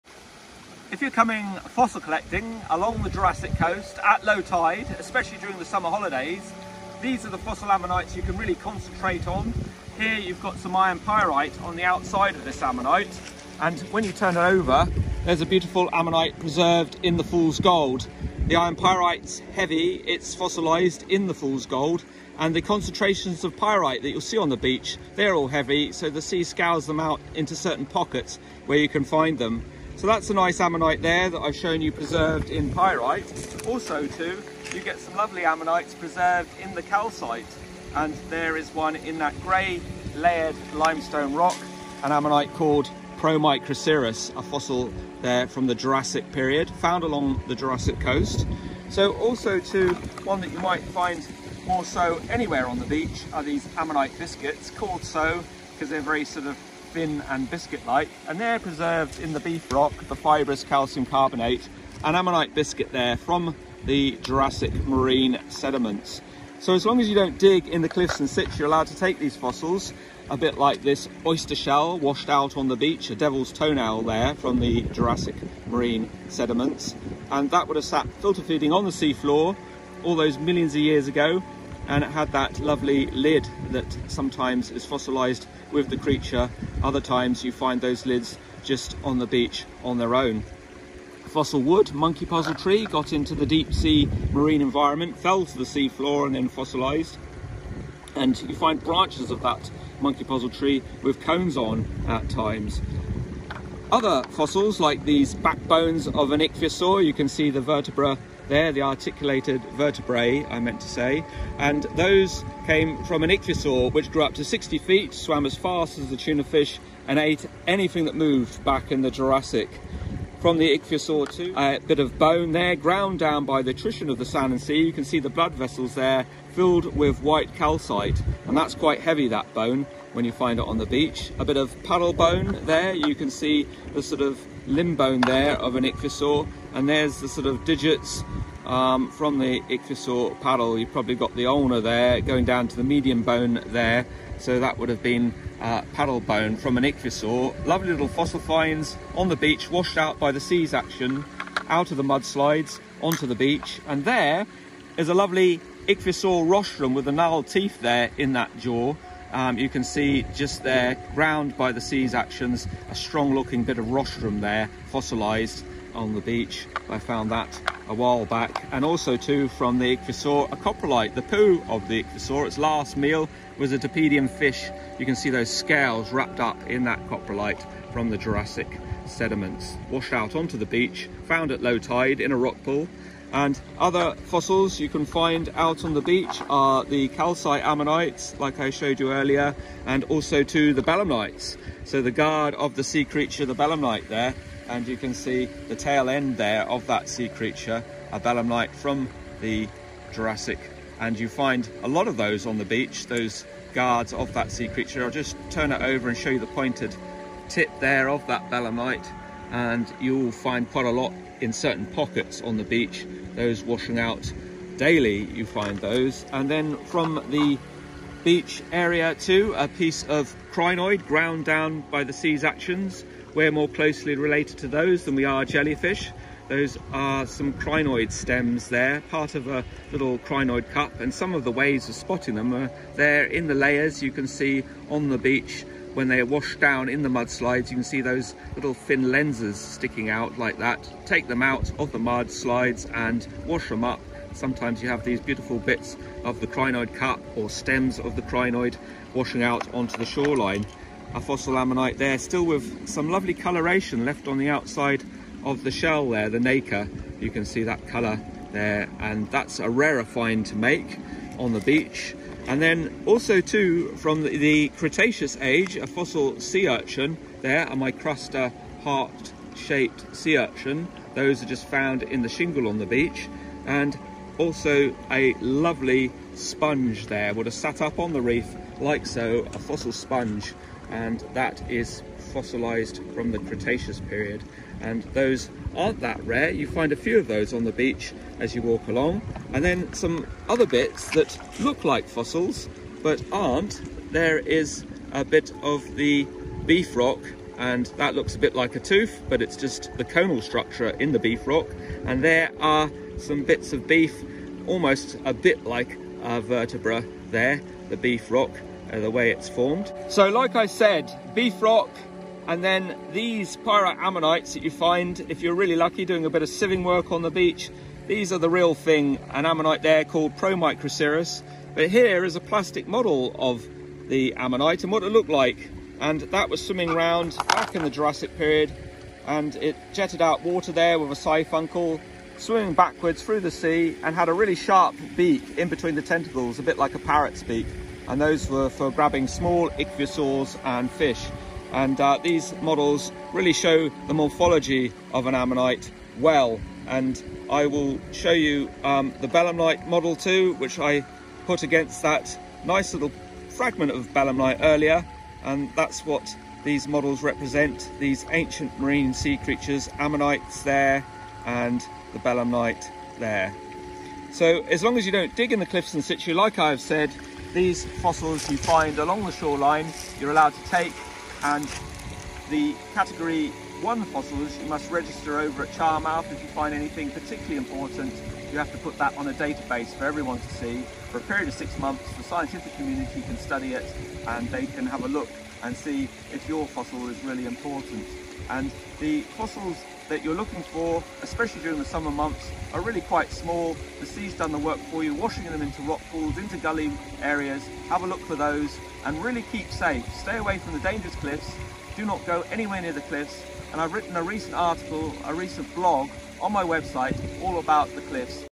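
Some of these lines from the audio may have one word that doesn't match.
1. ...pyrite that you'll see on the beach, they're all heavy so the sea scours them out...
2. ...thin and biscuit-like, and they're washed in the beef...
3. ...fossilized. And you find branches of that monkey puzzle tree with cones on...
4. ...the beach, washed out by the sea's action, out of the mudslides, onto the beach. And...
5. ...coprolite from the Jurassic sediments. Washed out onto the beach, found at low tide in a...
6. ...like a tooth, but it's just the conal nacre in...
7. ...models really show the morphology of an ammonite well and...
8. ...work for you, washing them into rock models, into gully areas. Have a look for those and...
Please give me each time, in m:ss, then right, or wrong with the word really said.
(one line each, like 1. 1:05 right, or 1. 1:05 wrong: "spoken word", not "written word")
1. 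0:23 right
2. 0:56 wrong: "preserved", not "washed"
3. 1:36 right
4. 2:29 right
5. 2:57 right
6. 4:58 wrong: "structure", not "nacre"
7. 5:42 right
8. 6:34 wrong: "pools", not "models".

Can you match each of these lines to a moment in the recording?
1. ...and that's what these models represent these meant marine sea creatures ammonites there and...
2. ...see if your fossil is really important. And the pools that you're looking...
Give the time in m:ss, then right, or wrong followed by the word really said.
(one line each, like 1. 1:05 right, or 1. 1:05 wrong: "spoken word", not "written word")
1. 5:55 wrong: "ancient", not "meant"
2. 6:25 wrong: "fossils", not "pools".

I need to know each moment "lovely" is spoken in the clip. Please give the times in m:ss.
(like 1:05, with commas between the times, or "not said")
0:35, 1:22, 2:27, 2:35, 4:13, 4:35.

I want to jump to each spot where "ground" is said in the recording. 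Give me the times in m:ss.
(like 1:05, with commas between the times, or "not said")
2:02, 2:41, 3:41.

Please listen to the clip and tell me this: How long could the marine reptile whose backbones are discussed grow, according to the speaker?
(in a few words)
60 feet.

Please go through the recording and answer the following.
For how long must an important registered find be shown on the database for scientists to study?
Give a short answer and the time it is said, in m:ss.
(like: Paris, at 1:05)
6 months, at 6:21.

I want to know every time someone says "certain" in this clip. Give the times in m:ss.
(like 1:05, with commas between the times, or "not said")
0:27, 3:31.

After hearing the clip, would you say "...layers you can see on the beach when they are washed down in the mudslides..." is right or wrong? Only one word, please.
right.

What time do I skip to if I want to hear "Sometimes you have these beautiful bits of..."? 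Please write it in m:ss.
4:04.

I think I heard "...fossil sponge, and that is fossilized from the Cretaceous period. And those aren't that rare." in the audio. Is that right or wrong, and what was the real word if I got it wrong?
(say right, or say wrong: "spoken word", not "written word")
right.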